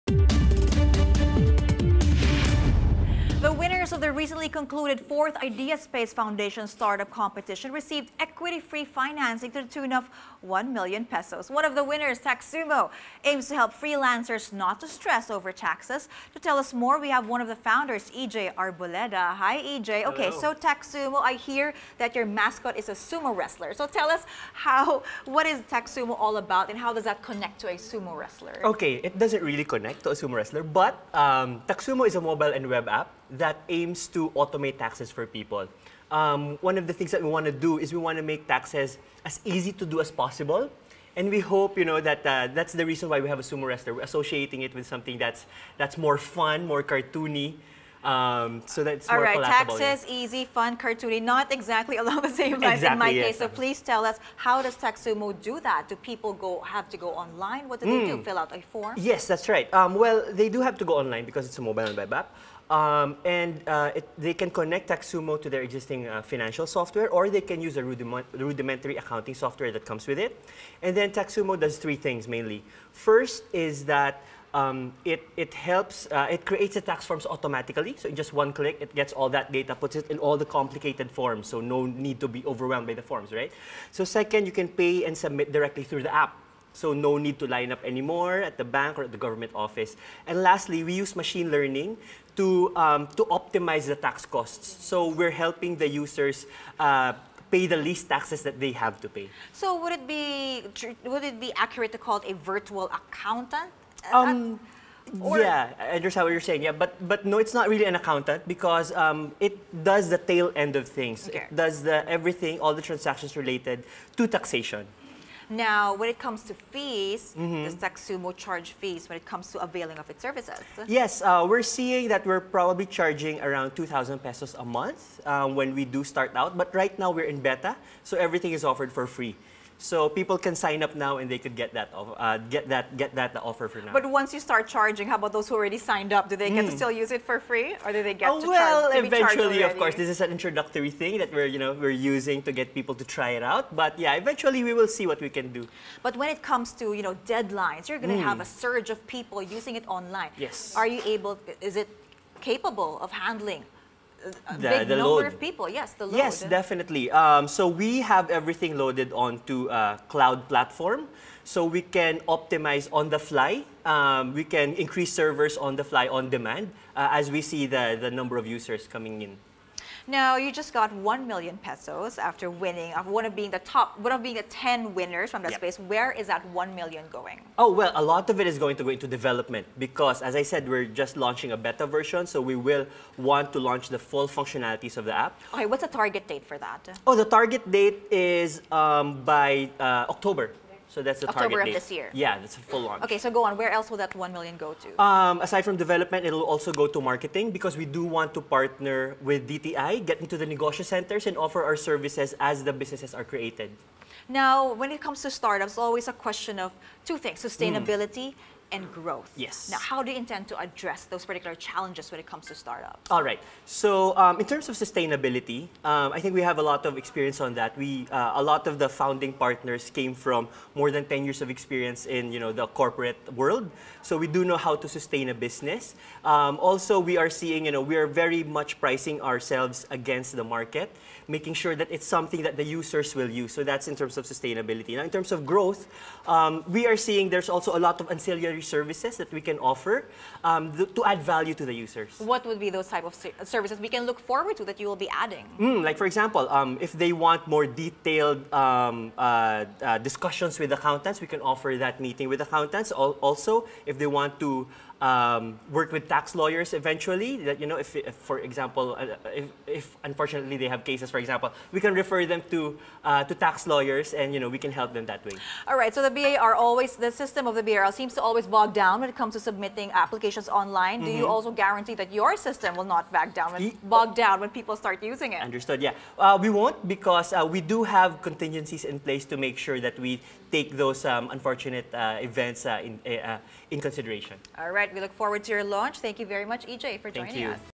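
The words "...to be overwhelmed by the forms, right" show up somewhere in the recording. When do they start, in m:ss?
1:22.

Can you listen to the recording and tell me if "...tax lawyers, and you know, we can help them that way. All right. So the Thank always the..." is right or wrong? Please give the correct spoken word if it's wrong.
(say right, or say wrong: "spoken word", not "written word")
wrong: "BIR", not "Thank".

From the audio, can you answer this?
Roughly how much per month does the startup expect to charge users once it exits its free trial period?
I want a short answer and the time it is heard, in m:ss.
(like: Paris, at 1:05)
2,000 pesos, at 2:03.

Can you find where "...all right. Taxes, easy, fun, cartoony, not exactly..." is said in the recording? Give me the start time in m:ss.
0:49.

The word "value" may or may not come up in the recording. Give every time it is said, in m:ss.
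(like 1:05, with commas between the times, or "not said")
4:01.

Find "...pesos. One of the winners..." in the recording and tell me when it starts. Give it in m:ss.
0:11.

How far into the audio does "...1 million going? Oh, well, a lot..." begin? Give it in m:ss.
2:56.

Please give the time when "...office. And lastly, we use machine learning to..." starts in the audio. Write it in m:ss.
1:29.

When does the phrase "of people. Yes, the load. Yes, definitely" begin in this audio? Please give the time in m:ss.
2:35.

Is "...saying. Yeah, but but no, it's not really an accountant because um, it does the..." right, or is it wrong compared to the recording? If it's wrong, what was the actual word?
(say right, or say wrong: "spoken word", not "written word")
right.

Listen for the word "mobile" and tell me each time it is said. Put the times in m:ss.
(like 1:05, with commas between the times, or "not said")
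0:32, 1:01.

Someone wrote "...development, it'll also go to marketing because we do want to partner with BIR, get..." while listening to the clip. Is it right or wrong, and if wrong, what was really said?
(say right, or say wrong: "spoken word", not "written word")
wrong: "DTI", not "BIR".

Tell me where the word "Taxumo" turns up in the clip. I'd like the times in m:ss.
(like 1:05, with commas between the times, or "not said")
0:12, 0:20, 0:25, 0:54, 1:04, 1:11, 1:57.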